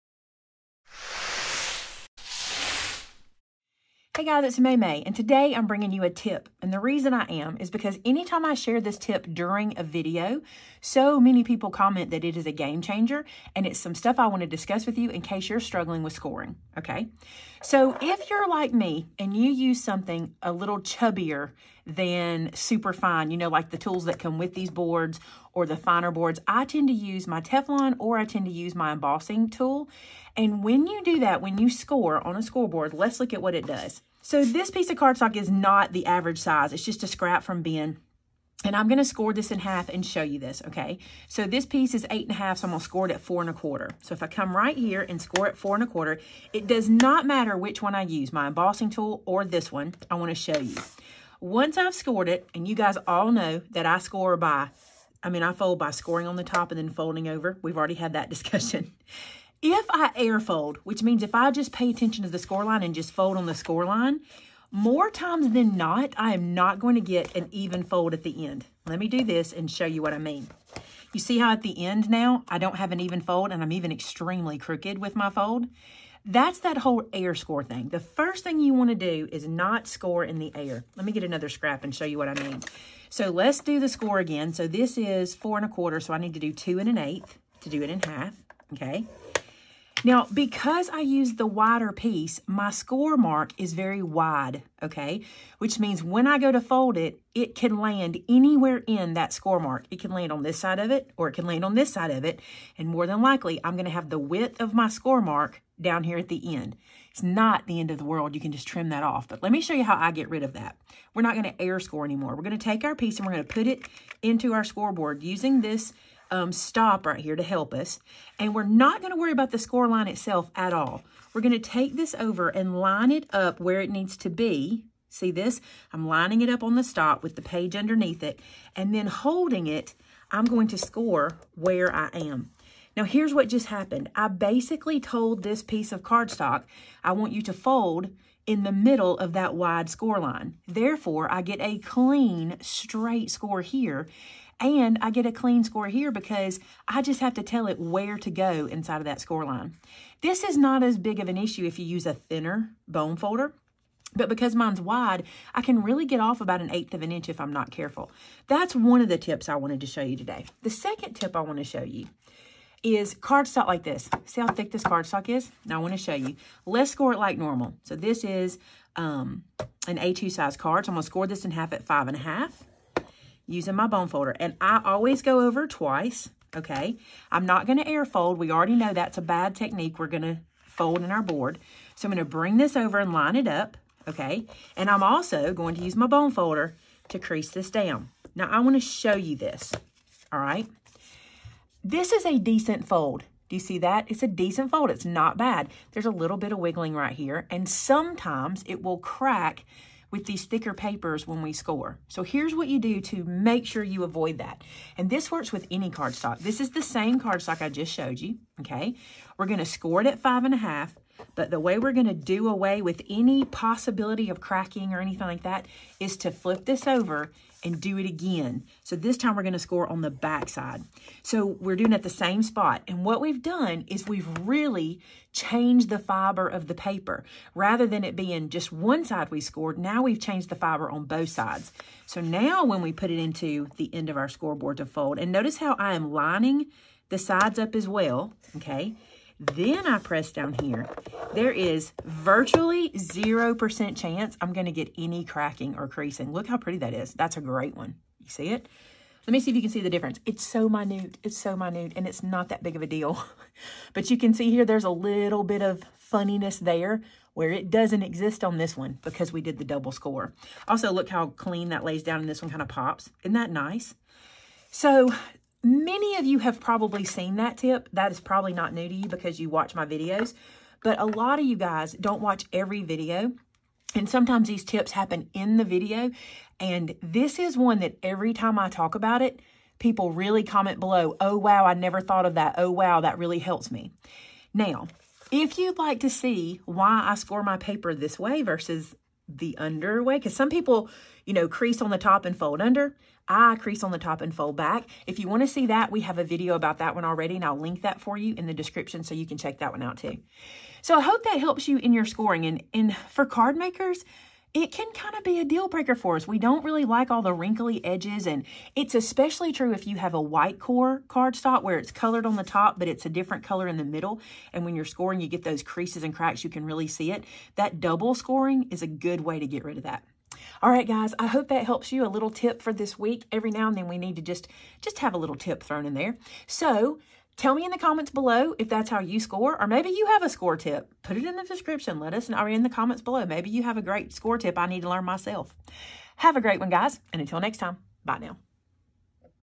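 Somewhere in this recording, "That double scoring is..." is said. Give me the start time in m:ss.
5:17.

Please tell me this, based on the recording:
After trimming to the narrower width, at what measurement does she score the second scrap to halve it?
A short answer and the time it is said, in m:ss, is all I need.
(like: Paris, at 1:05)
2 1/8, at 1:26.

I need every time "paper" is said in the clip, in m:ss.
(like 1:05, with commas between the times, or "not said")
3:20, 3:46, 4:47.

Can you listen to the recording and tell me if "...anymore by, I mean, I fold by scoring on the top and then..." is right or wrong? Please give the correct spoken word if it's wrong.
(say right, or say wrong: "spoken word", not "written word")
wrong: "score", not "anymore".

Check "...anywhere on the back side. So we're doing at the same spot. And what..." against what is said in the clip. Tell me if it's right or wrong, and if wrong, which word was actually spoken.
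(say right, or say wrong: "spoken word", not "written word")
wrong: "score", not "anywhere".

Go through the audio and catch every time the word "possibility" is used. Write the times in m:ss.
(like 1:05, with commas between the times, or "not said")
3:33.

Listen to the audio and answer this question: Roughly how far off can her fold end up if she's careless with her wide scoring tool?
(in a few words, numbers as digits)
an eighth of an inch.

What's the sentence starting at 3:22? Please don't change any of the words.
So here's what you do to make sure you avoid that.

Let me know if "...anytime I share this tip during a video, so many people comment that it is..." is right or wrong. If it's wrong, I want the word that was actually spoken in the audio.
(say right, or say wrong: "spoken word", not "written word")
right.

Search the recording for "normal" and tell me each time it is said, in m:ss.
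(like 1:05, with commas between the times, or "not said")
2:47.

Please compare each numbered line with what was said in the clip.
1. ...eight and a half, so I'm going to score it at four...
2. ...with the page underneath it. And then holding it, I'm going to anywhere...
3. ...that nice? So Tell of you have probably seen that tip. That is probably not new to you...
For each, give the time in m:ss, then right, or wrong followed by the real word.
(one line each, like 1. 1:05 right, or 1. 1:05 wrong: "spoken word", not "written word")
1. 0:42 right
2. 2:07 wrong: "score", not "anywhere"
3. 4:23 wrong: "Many", not "Tell".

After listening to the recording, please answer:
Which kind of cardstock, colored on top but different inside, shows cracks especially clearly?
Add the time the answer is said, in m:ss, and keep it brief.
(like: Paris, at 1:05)
white core cardstock, at 5:10.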